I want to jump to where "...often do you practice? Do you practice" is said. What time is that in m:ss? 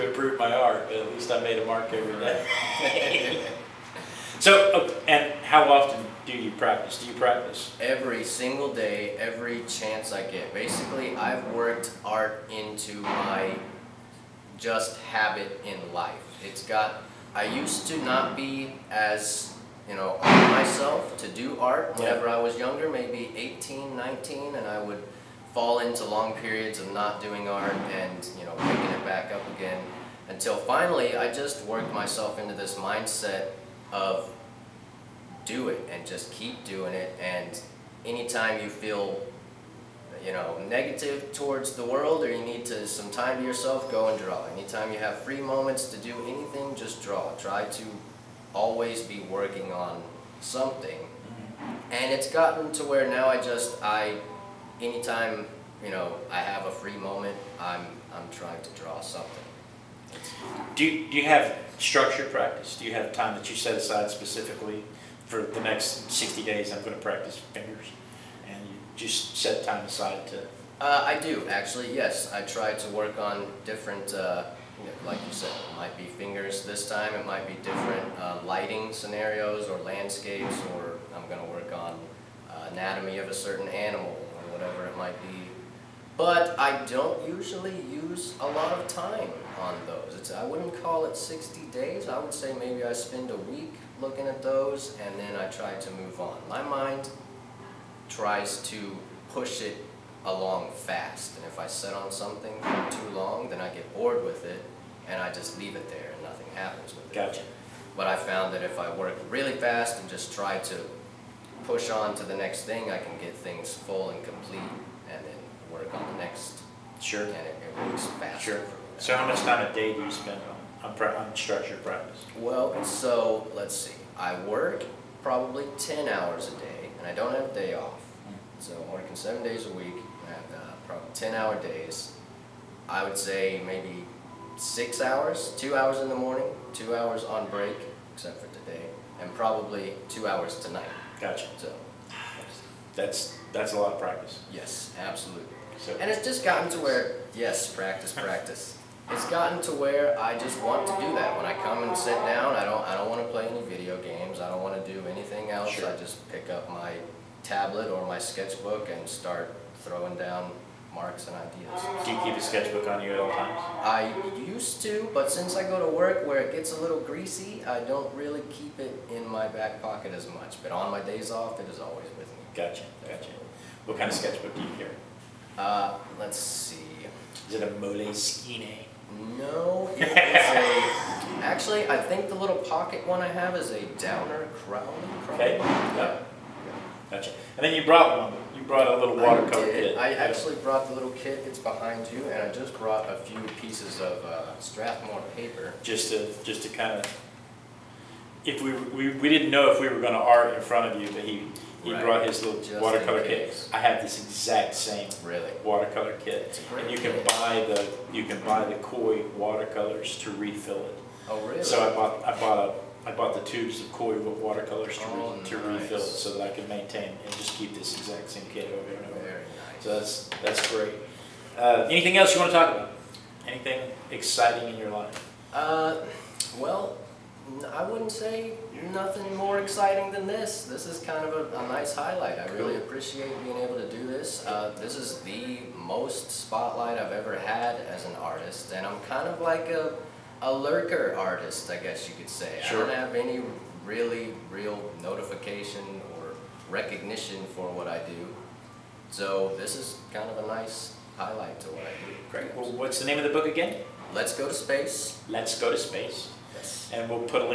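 0:05.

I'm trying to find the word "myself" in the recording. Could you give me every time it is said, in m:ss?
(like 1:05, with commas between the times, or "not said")
0:20, 0:31.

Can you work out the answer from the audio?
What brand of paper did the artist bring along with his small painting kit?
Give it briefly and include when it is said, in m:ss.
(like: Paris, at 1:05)
Strathmore, at 3:14.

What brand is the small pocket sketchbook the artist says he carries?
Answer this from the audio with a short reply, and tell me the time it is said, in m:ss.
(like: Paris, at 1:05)
Downer crown, at 3:03.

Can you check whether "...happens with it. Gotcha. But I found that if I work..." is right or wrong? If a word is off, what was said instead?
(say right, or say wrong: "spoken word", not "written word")
right.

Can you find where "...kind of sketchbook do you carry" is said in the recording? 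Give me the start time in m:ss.
2:53.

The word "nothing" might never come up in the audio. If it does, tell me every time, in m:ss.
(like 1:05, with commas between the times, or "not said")
1:46, 3:48.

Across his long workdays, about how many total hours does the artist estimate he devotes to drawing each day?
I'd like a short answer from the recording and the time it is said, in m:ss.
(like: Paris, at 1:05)
6 hours, at 2:14.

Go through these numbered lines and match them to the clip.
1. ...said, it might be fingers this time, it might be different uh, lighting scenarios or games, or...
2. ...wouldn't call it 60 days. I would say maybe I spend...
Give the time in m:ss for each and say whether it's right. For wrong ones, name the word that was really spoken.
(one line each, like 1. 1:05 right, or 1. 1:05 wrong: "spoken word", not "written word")
1. 1:15 wrong: "landscapes", not "games"
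2. 1:30 right.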